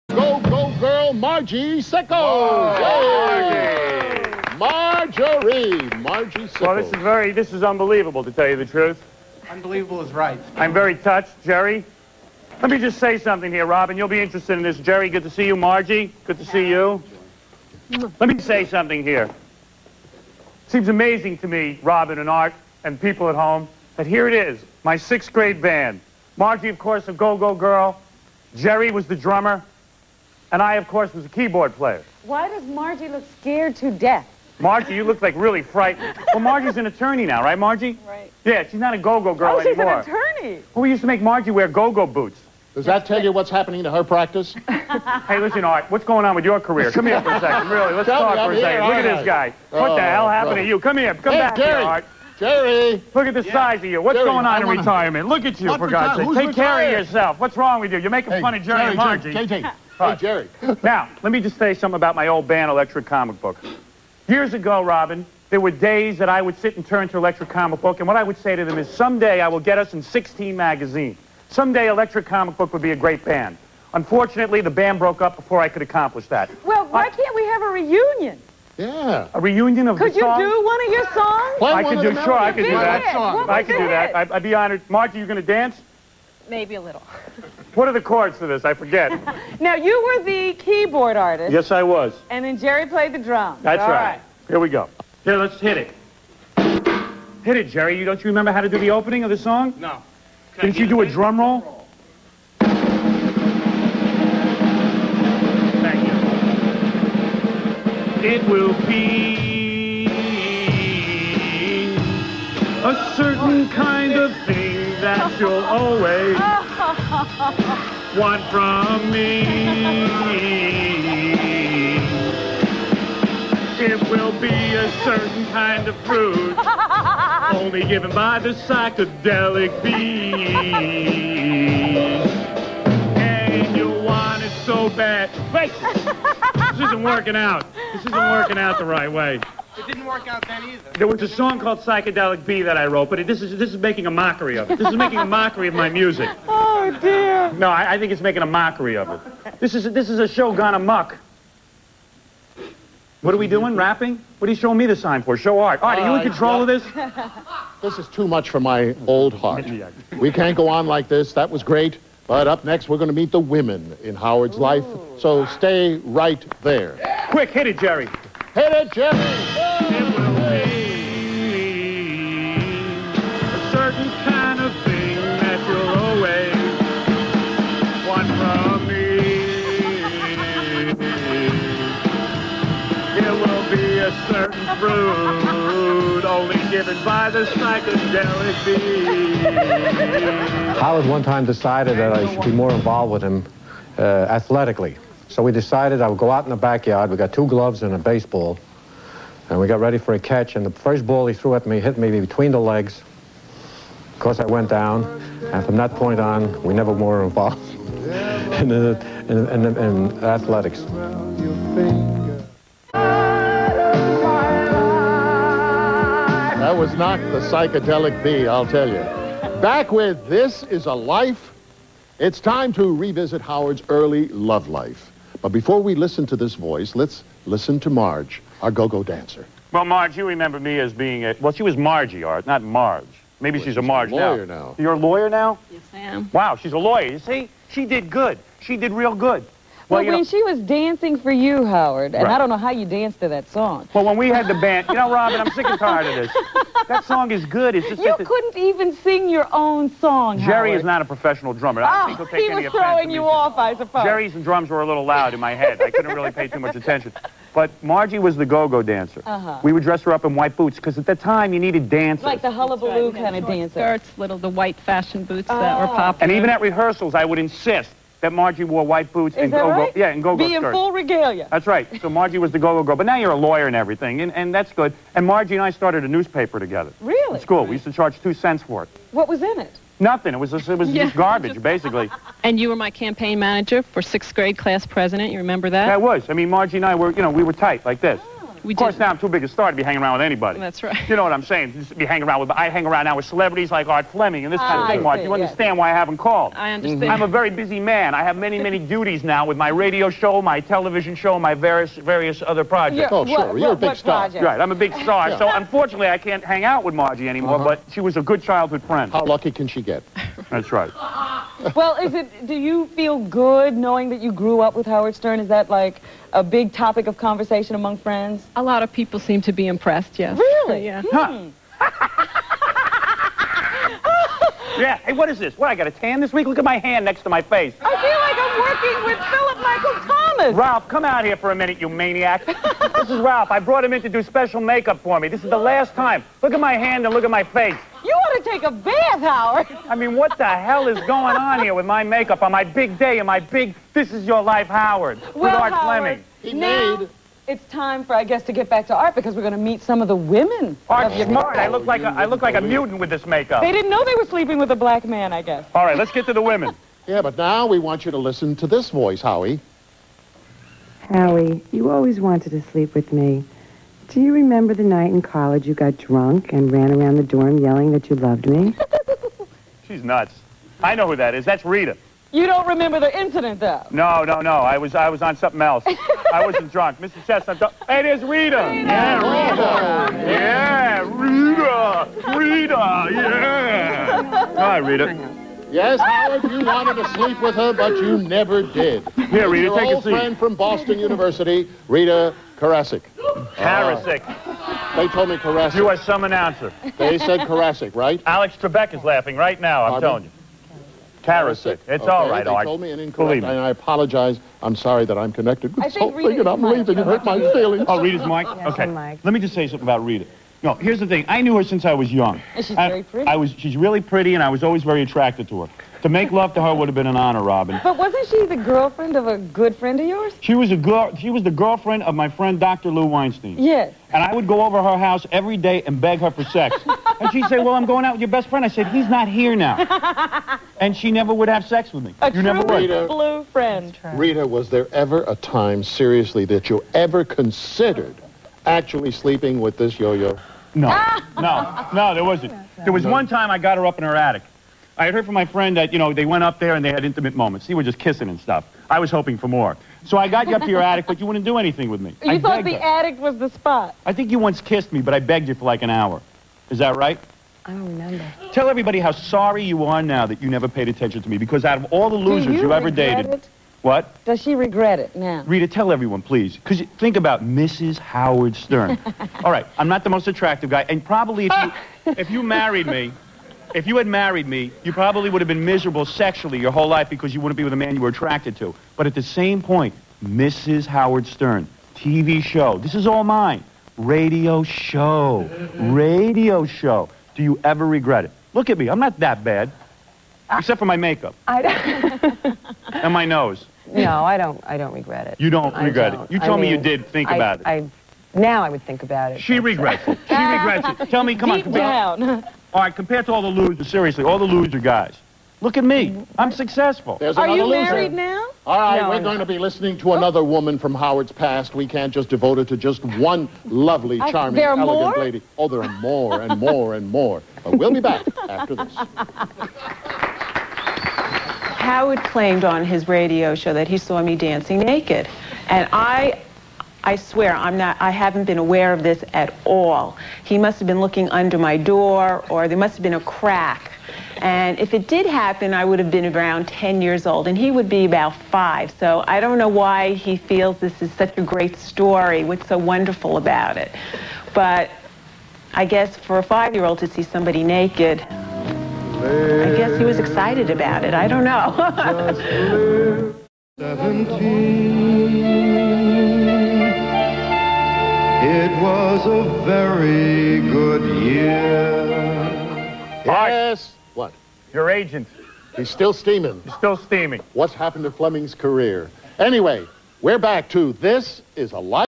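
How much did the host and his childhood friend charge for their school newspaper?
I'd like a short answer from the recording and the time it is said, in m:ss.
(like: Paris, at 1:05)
2 cents, at 4:38.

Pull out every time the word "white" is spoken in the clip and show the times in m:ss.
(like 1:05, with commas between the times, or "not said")
4:20, 4:24, 4:28.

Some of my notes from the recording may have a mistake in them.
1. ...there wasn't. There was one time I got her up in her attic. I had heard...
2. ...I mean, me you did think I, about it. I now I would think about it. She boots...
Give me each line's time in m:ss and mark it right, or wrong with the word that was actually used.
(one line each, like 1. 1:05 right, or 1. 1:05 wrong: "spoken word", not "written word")
1. 7:22 right
2. 8:16 wrong: "regrets", not "boots".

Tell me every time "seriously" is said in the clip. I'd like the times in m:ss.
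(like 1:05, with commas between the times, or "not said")
7:15, 8:23.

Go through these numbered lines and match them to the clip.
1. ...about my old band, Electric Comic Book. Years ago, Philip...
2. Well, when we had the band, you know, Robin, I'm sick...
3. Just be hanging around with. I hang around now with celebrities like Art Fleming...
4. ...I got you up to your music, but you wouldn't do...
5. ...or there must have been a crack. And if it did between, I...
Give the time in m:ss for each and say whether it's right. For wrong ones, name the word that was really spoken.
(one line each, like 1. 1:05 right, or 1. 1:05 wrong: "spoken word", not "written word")
1. 1:01 wrong: "Robin", not "Philip"
2. 4:03 right
3. 4:51 right
4. 7:30 wrong: "attic", not "music"
5. 8:52 wrong: "happen", not "between".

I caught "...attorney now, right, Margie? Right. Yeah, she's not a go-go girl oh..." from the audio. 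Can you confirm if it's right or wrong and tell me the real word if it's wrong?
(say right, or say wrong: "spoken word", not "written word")
right.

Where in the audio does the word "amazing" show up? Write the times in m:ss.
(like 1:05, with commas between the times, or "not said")
0:20.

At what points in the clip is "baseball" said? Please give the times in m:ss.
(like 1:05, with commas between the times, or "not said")
3:17.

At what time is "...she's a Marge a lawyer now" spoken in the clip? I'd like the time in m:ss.
3:53.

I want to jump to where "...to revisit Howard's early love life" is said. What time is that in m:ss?
3:42.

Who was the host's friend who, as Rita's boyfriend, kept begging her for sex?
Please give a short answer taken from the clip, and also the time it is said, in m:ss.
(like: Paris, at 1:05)
Dr. Lou Weinstein, at 7:02.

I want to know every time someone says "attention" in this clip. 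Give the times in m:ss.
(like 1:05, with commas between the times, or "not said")
4:16, 7:40.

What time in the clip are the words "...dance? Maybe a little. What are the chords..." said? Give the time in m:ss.
1:25.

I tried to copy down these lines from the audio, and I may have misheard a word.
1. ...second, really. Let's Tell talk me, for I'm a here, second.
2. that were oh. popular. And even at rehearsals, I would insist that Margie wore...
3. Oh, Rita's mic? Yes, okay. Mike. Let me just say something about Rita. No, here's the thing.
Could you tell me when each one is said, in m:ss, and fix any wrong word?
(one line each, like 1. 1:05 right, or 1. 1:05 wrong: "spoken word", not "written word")
1. 0:47 right
2. 4:25 right
3. 6:47 right.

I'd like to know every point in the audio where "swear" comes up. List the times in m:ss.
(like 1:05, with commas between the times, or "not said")
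8:47.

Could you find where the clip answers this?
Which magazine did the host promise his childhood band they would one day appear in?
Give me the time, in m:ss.
1:10.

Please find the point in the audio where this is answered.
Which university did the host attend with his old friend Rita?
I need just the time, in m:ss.
6:30.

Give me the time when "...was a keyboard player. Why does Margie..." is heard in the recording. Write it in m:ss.
0:31.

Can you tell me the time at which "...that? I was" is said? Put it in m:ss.
4:45.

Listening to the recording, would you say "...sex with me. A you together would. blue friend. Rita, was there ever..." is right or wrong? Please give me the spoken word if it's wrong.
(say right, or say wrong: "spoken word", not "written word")
wrong: "never", not "together".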